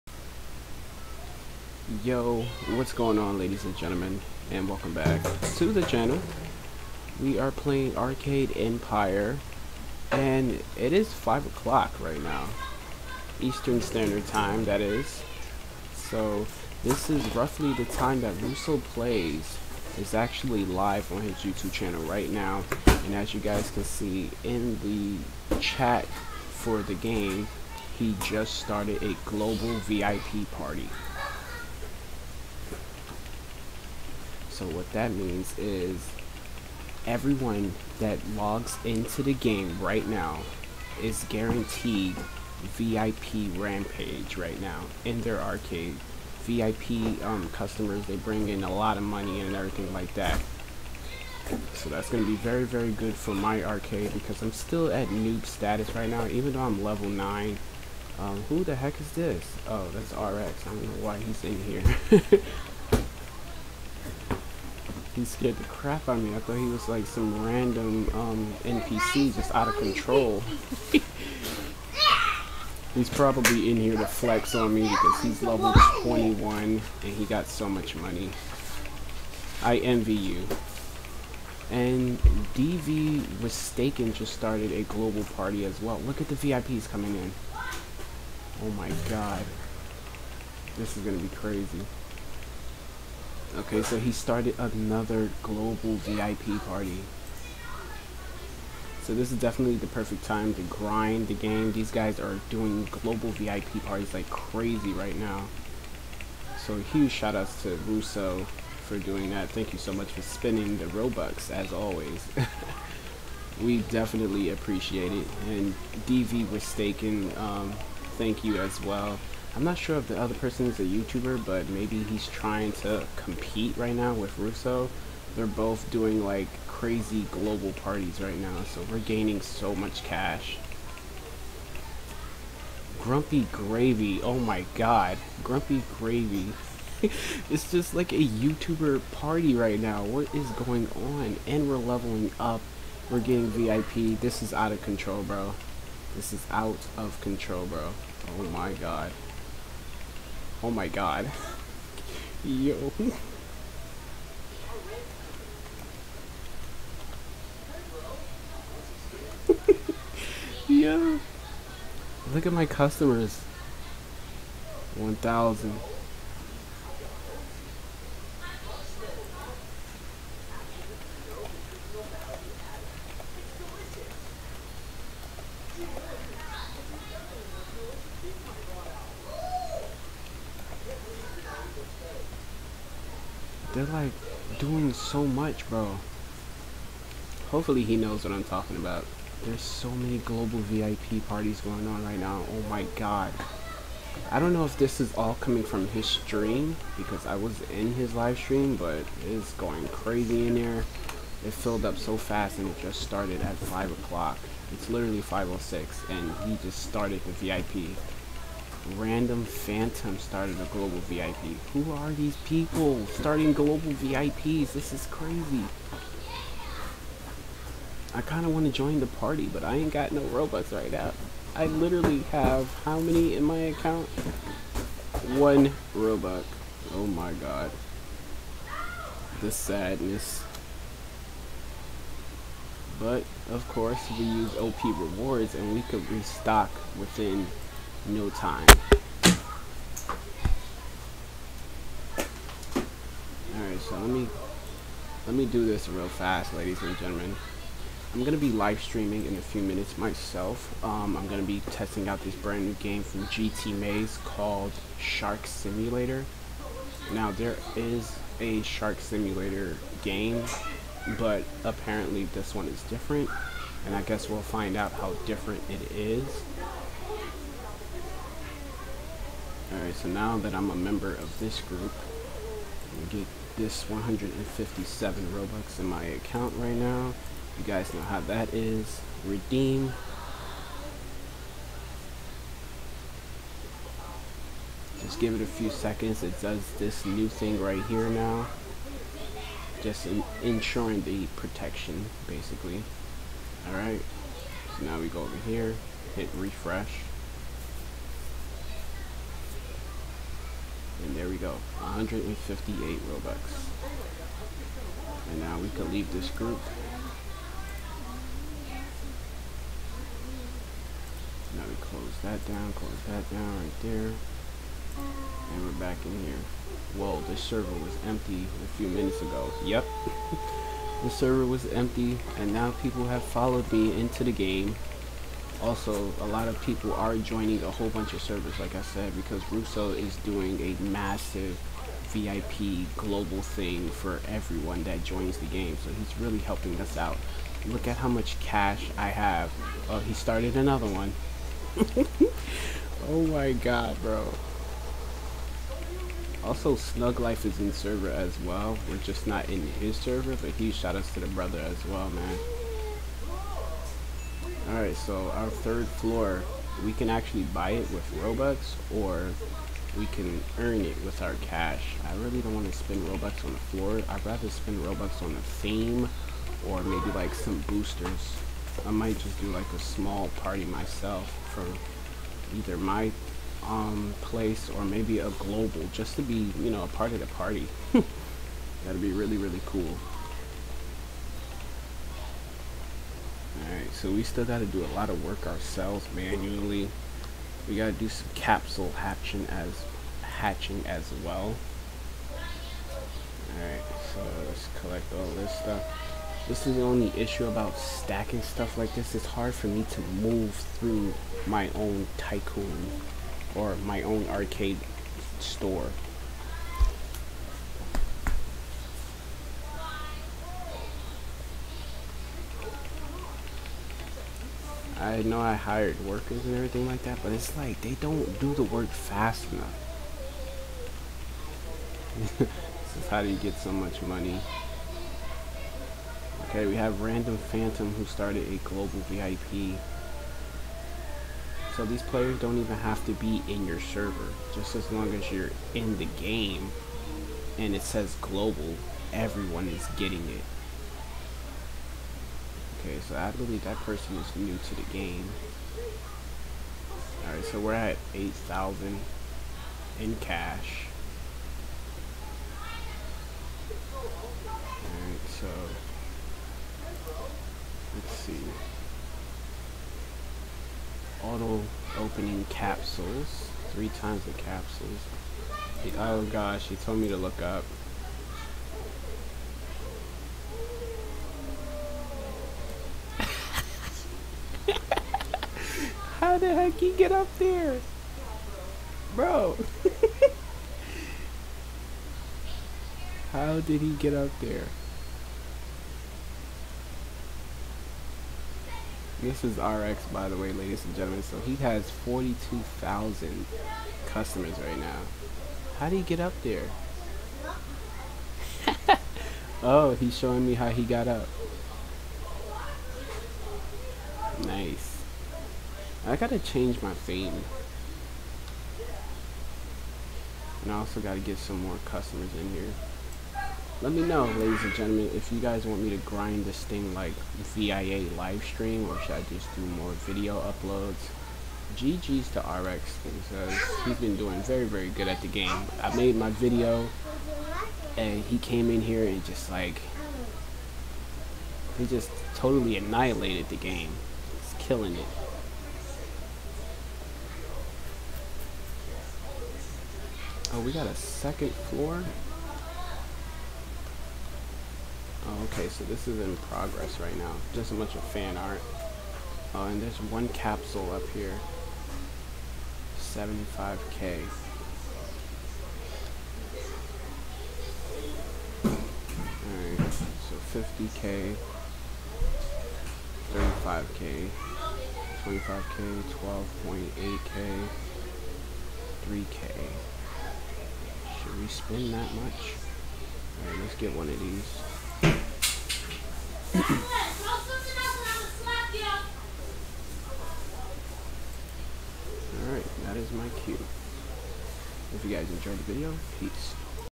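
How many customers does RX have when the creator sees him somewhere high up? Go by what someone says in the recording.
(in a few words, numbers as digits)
42,000.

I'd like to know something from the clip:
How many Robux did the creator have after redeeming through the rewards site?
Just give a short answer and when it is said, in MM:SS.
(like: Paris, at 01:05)
158, at 05:01.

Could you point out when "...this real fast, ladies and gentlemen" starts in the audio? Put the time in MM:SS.
04:05.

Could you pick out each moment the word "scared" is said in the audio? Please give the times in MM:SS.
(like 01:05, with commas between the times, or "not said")
01:05.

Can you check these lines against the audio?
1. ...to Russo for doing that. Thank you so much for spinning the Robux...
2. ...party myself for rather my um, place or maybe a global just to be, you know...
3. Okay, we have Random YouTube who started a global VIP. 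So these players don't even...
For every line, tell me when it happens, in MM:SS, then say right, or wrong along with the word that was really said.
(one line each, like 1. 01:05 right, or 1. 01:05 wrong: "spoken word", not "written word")
1. 01:47 right
2. 06:10 wrong: "either", not "rather"
3. 07:06 wrong: "Phantom", not "YouTube".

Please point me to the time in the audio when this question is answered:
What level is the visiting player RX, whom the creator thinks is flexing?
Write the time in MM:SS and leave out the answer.
01:15.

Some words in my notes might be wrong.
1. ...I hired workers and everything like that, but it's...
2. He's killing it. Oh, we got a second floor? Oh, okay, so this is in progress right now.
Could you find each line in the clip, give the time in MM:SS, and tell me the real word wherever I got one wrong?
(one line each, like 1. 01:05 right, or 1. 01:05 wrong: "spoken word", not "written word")
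1. 06:55 right
2. 08:54 right.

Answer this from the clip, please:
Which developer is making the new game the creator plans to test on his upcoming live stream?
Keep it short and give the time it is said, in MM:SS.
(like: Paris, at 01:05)
GT Maze, at 04:13.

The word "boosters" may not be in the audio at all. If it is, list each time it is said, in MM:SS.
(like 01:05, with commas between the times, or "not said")
06:07.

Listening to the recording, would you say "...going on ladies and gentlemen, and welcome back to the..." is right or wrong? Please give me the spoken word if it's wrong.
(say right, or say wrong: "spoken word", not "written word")
right.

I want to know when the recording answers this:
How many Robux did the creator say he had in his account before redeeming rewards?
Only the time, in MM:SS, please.
03:45.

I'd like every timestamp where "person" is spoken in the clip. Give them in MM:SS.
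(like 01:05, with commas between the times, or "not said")
02:00, 07:23.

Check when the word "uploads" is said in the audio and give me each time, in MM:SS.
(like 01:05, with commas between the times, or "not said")
08:40.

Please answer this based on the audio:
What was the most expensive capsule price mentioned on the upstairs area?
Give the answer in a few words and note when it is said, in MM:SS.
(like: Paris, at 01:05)
75k, at 09:12.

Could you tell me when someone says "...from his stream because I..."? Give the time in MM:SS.
03:15.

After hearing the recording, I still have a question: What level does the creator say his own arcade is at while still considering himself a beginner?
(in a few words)
9.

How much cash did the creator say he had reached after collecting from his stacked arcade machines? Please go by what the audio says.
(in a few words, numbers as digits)
8,000.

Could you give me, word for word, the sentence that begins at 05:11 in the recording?
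Now we close that down, close that down right there.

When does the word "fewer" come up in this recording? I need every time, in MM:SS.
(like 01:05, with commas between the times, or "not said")
not said.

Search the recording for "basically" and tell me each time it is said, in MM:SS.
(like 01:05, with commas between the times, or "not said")
04:52.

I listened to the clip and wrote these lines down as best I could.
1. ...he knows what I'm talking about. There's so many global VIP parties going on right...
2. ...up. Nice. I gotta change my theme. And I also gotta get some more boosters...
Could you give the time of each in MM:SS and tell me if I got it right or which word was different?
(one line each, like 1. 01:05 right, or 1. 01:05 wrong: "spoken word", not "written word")
1. 03:07 right
2. 08:21 wrong: "customers", not "boosters".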